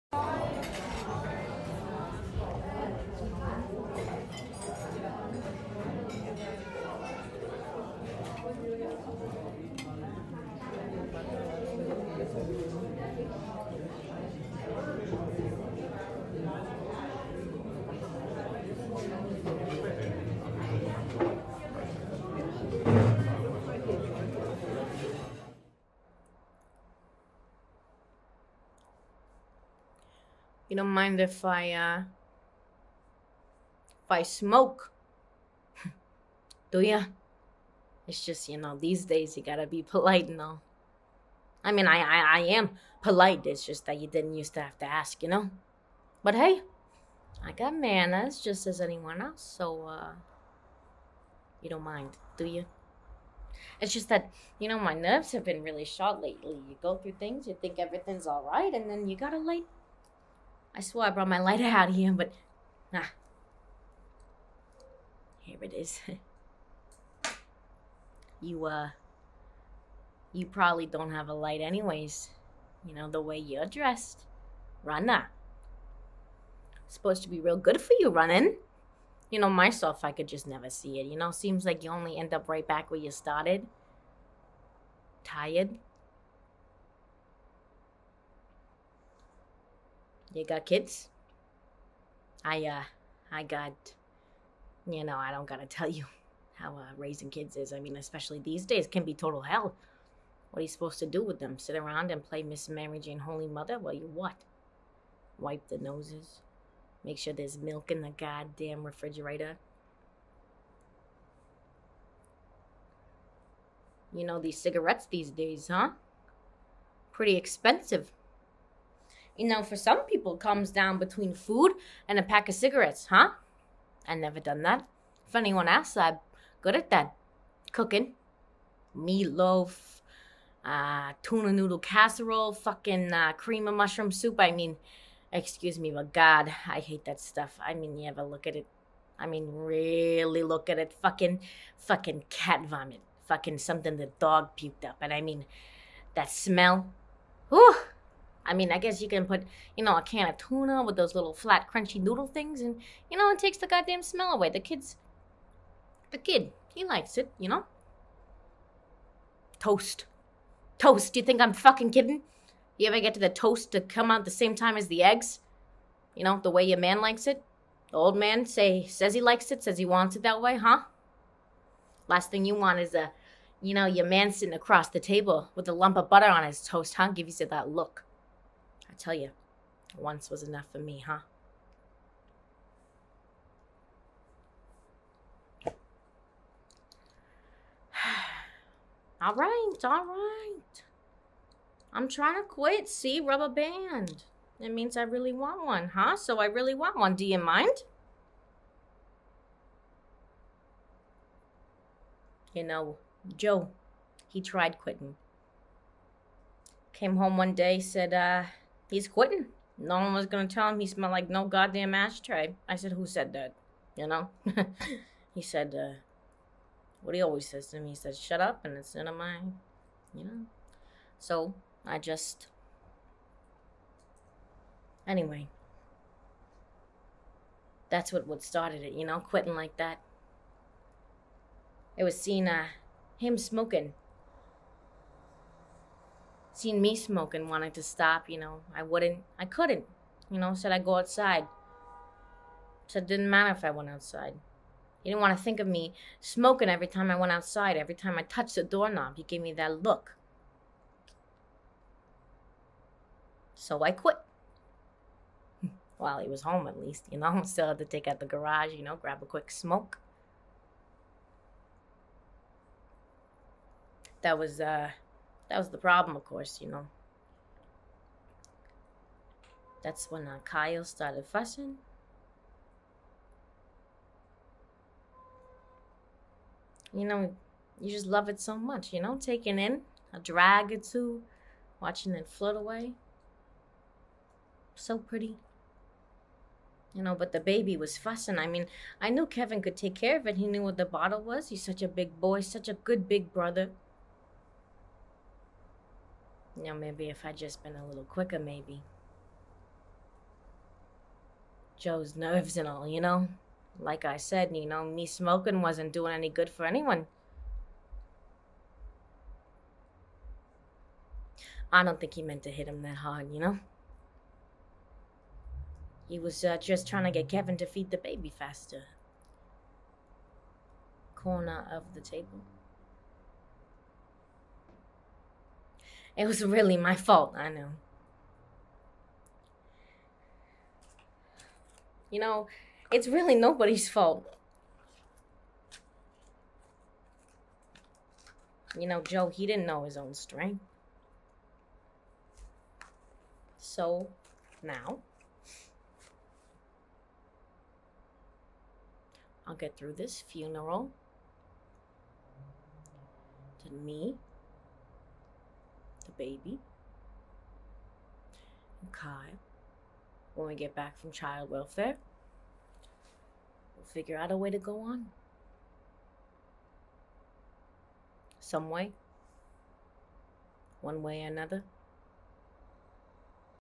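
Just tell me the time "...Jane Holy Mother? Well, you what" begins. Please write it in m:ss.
1:42.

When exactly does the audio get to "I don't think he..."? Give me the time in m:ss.
5:11.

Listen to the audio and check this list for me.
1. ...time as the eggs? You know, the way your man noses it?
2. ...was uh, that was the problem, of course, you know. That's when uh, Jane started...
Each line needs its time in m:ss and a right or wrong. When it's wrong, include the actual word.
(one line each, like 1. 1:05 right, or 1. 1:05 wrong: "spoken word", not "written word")
1. 2:44 wrong: "likes", not "noses"
2. 4:24 wrong: "Kyle", not "Jane".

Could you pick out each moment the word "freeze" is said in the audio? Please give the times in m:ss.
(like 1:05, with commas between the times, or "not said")
not said.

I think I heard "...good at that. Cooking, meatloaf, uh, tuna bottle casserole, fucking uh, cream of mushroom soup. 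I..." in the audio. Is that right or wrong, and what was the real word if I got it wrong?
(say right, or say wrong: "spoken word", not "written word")
wrong: "noodle", not "bottle".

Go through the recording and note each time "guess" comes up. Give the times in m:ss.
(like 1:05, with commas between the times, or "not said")
2:28.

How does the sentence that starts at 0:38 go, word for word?
It's just, you know, these days you gotta be polite and all.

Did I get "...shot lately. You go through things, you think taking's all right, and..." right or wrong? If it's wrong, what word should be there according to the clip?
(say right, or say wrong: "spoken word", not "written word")
wrong: "everything", not "taking".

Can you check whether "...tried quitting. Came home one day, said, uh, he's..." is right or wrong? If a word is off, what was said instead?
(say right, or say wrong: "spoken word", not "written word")
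right.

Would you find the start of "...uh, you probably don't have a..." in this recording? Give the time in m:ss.
1:08.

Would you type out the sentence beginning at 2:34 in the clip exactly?
The kids, the kid, he likes it, you know.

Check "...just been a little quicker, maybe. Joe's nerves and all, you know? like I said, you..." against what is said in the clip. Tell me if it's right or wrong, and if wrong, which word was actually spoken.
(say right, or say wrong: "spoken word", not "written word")
right.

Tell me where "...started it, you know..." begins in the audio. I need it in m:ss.
3:48.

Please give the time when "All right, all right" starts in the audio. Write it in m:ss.
3:09.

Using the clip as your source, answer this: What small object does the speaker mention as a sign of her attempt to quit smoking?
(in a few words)
Rubber band.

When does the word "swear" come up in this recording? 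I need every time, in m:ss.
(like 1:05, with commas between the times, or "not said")
1:00.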